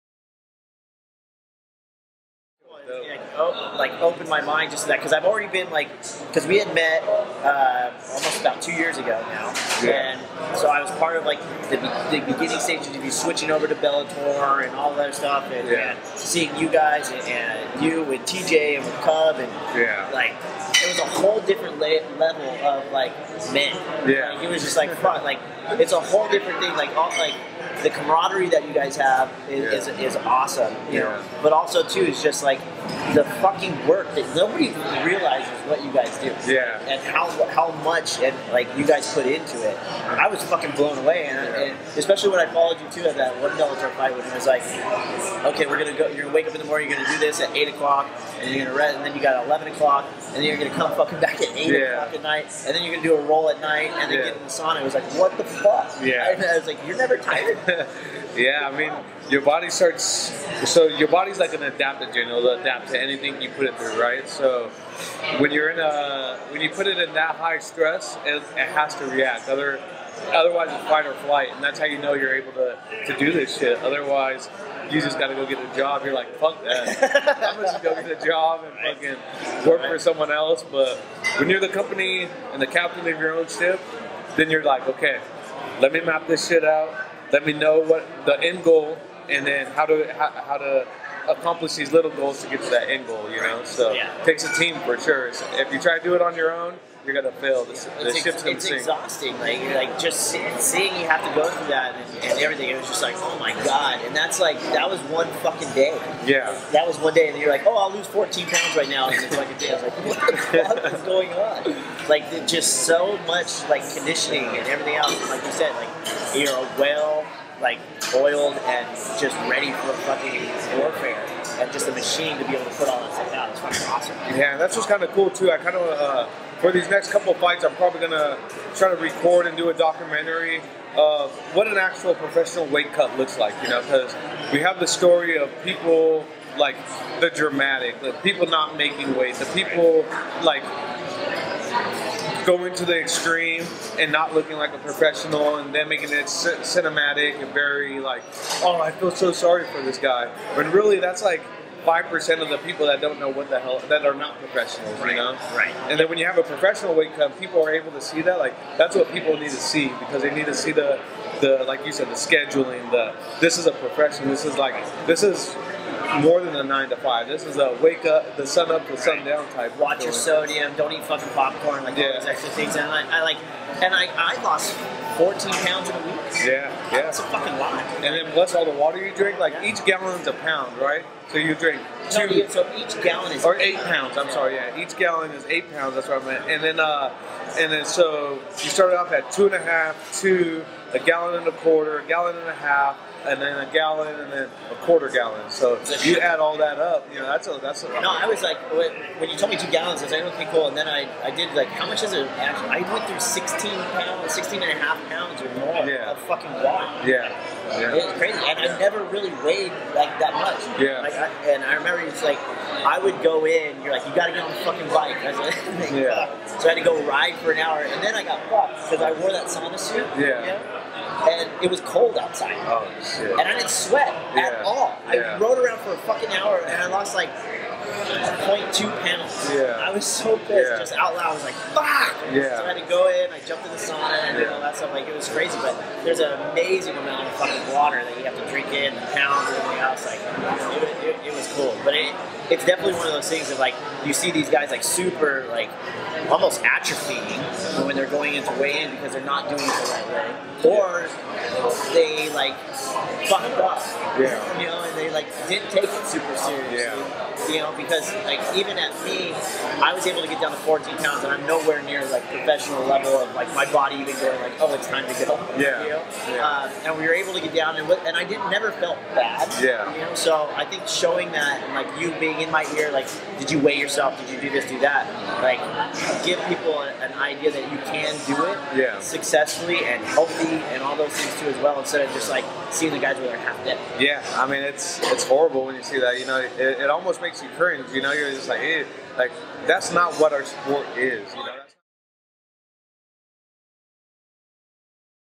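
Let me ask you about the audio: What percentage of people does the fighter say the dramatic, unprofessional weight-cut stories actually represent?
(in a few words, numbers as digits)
5%.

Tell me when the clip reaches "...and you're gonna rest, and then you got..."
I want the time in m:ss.
0:48.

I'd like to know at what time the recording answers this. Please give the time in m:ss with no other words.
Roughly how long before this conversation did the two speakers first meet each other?
0:08.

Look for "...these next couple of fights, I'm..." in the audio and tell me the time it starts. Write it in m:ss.
2:06.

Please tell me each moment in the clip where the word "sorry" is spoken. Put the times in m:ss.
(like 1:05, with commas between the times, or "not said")
2:29, 3:04.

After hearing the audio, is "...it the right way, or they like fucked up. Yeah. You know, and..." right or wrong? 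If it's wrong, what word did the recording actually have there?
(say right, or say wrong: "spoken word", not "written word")
right.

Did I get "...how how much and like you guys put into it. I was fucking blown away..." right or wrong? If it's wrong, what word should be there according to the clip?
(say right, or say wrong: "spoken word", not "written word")
right.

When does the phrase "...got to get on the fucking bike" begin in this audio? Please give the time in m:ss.
3:34.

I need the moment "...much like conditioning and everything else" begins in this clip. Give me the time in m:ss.
1:53.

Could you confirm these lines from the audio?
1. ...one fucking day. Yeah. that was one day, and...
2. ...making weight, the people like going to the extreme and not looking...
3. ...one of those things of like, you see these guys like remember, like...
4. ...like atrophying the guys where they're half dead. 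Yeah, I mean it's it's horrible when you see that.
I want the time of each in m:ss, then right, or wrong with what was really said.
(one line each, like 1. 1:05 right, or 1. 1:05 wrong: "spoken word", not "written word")
1. 1:45 right
2. 2:18 right
3. 4:02 wrong: "super", not "remember"
4. 4:42 wrong: "seeing", not "atrophying".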